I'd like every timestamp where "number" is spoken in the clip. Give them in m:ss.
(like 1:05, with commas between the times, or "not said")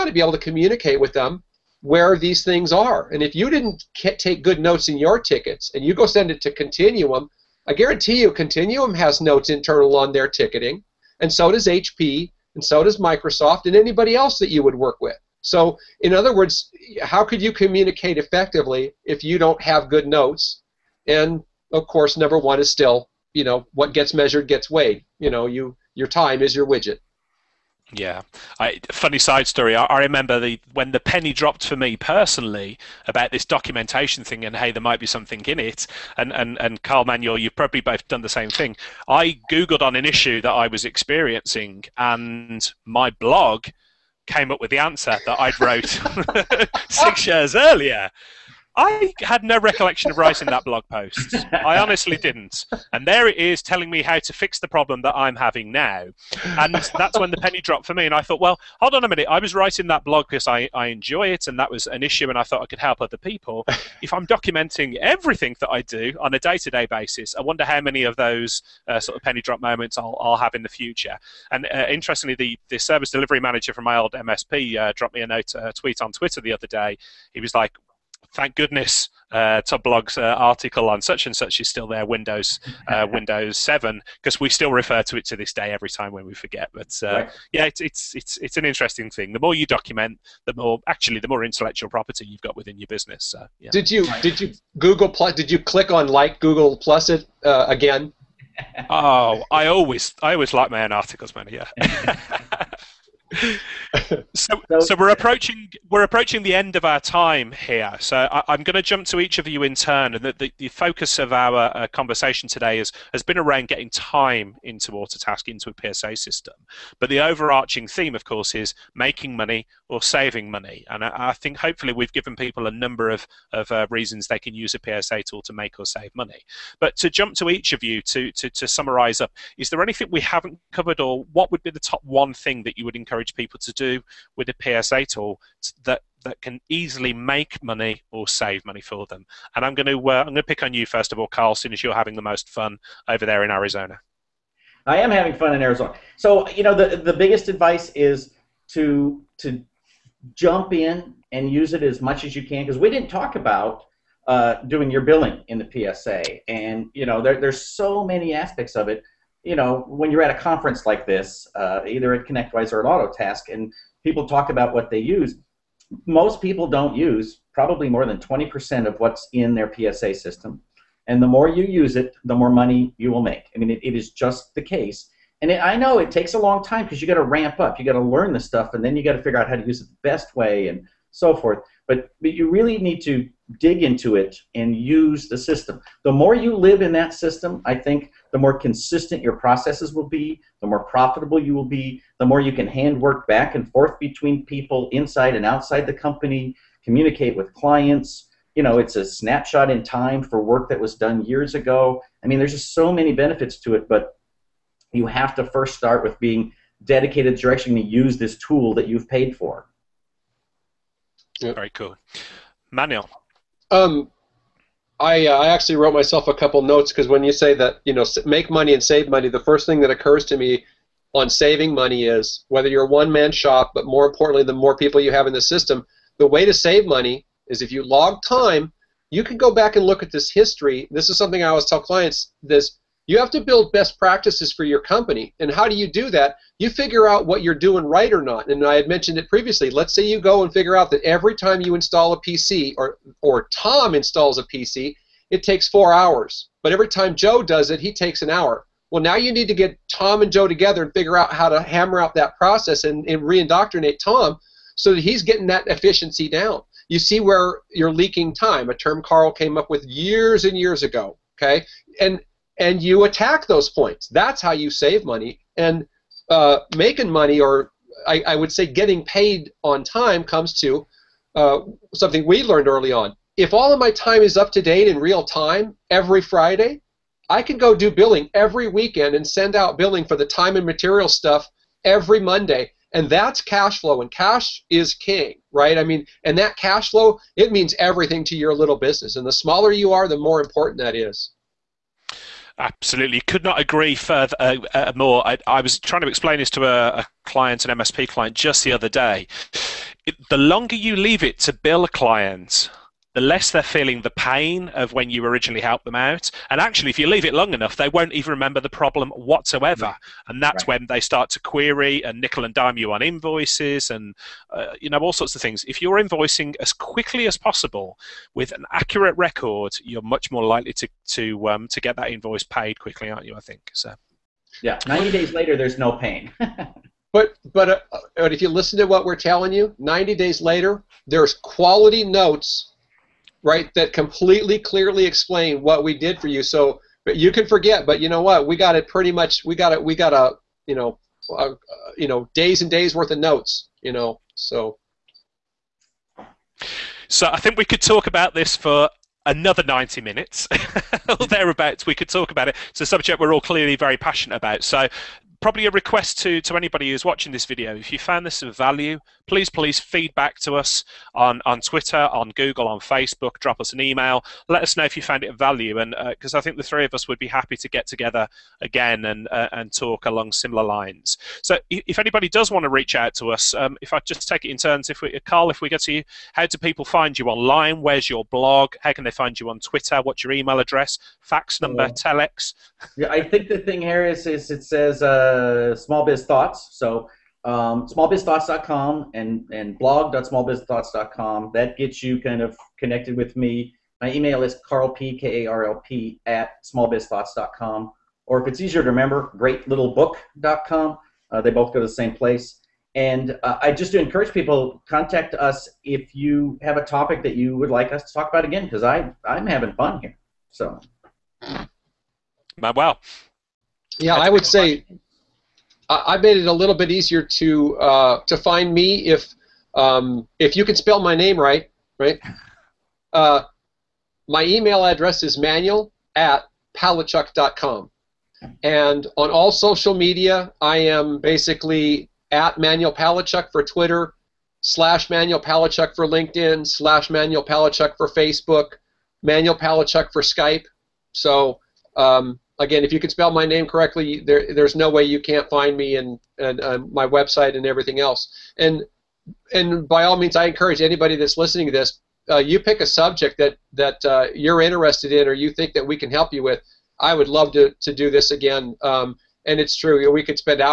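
0:22, 2:02, 6:21.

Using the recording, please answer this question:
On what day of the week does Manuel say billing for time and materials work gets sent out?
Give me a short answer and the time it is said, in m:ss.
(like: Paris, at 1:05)
Monday, at 4:42.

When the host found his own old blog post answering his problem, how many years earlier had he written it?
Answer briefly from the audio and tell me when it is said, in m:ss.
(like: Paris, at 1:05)
6, at 0:46.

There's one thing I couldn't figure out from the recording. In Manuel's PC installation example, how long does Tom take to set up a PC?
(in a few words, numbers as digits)
4 hours.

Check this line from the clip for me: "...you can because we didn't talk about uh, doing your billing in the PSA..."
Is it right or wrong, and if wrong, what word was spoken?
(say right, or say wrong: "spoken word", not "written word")
right.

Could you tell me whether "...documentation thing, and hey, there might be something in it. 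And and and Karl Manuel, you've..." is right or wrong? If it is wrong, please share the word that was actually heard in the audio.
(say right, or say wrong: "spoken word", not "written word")
right.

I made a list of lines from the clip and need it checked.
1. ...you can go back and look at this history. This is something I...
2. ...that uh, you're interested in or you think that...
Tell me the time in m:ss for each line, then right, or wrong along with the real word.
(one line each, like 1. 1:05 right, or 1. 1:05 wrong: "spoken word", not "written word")
1. 3:49 right
2. 7:33 right.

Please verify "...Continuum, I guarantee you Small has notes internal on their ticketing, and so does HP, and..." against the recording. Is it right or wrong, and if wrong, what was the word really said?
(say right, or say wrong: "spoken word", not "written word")
wrong: "Continuum", not "Small".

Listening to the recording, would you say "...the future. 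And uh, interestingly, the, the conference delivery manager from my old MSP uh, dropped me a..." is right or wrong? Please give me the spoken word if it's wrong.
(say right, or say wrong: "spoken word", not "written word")
wrong: "service", not "conference".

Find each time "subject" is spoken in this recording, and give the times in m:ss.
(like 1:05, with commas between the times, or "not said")
5:52, 7:32.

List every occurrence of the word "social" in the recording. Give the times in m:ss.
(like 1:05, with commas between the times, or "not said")
7:09.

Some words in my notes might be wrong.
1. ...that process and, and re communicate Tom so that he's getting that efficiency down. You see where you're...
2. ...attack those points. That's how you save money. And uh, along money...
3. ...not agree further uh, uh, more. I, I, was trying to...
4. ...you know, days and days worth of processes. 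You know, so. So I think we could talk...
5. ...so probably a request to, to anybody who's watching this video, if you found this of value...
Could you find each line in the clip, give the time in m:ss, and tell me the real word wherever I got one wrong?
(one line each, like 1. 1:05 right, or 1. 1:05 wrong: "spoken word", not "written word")
1. 4:12 wrong: "indoctrinate", not "communicate"
2. 4:23 wrong: "making", not "along"
3. 4:53 right
4. 5:41 wrong: "notes", not "processes"
5. 5:54 right.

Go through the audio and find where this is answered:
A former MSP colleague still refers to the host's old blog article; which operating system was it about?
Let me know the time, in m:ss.
1:23.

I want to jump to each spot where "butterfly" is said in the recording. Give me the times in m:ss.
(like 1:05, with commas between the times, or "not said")
not said.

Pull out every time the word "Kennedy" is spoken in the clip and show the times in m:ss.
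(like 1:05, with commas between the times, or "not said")
not said.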